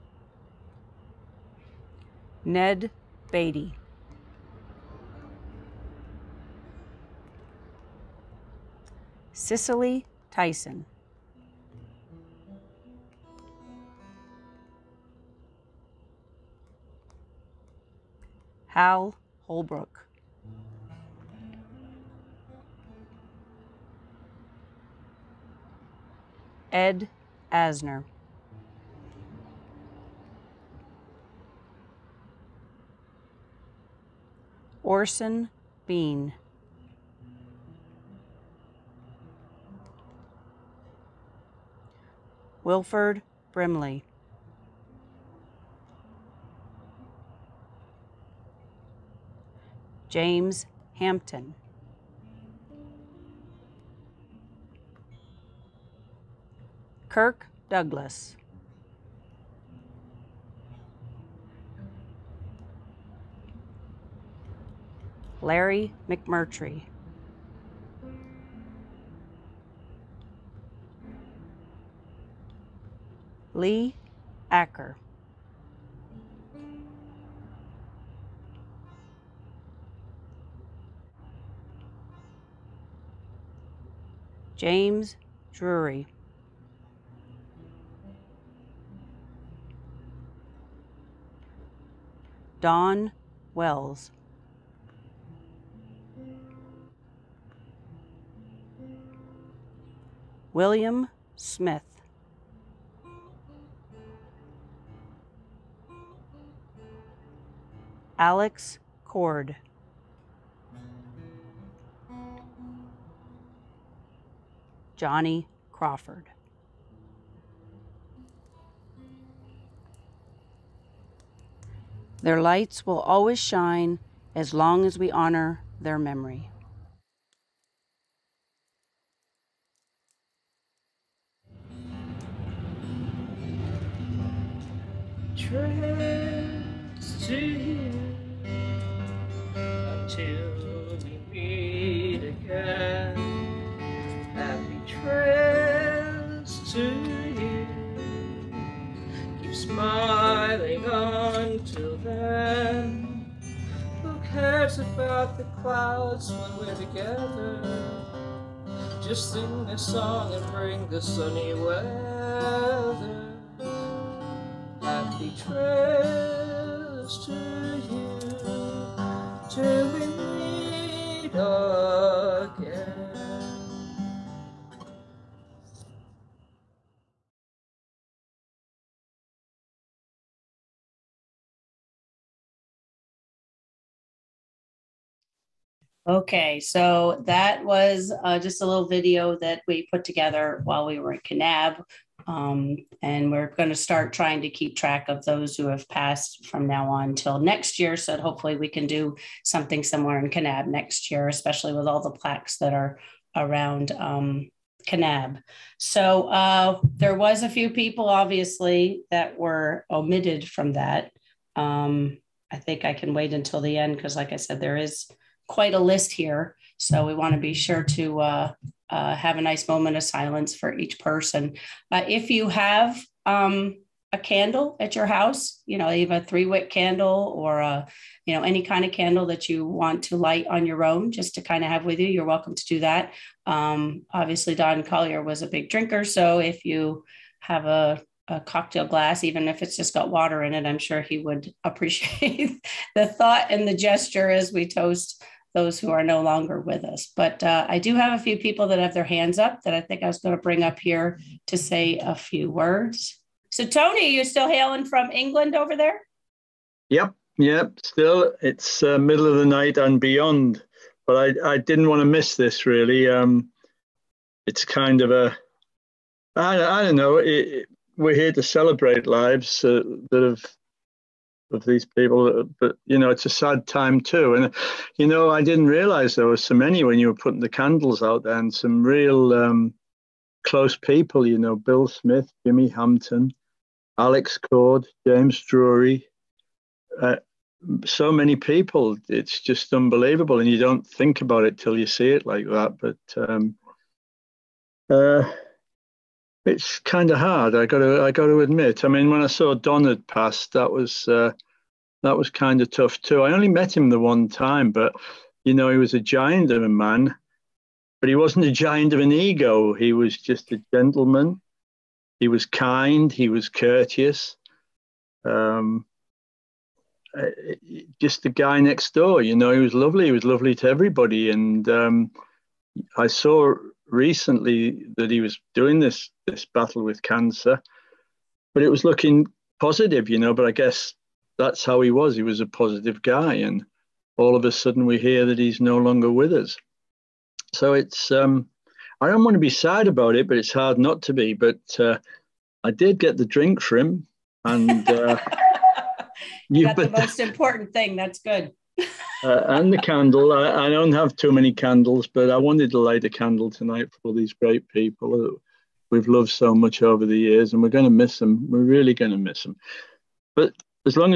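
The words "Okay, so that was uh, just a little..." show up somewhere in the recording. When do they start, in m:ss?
3:06.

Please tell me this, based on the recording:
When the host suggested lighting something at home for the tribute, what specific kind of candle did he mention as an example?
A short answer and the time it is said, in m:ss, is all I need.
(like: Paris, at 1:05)
three wick candle, at 3:46.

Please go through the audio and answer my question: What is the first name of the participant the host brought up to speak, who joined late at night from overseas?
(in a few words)
Tony.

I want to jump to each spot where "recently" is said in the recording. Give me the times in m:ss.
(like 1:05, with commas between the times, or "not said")
5:23.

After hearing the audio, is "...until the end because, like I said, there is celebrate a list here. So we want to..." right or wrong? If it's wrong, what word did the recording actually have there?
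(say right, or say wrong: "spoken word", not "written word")
wrong: "quite", not "celebrate".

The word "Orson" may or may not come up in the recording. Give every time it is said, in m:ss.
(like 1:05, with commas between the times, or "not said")
0:34.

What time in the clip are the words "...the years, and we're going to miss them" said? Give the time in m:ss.
5:57.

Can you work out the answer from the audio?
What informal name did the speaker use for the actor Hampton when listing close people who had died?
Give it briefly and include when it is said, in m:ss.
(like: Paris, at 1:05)
Jimmy Hampton, at 4:42.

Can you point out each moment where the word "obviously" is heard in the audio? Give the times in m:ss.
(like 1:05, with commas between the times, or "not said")
3:28, 3:54.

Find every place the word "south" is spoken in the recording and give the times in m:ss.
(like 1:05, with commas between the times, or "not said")
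not said.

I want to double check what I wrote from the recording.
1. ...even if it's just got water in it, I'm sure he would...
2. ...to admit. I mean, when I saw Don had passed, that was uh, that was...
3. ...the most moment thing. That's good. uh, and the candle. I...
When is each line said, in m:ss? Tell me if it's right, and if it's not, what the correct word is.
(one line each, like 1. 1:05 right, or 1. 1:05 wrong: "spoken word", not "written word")
1. 3:59 right
2. 4:58 right
3. 5:46 wrong: "important", not "moment".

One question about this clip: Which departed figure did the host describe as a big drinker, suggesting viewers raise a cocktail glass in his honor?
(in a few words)
Don Collier.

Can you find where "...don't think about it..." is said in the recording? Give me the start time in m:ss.
4:50.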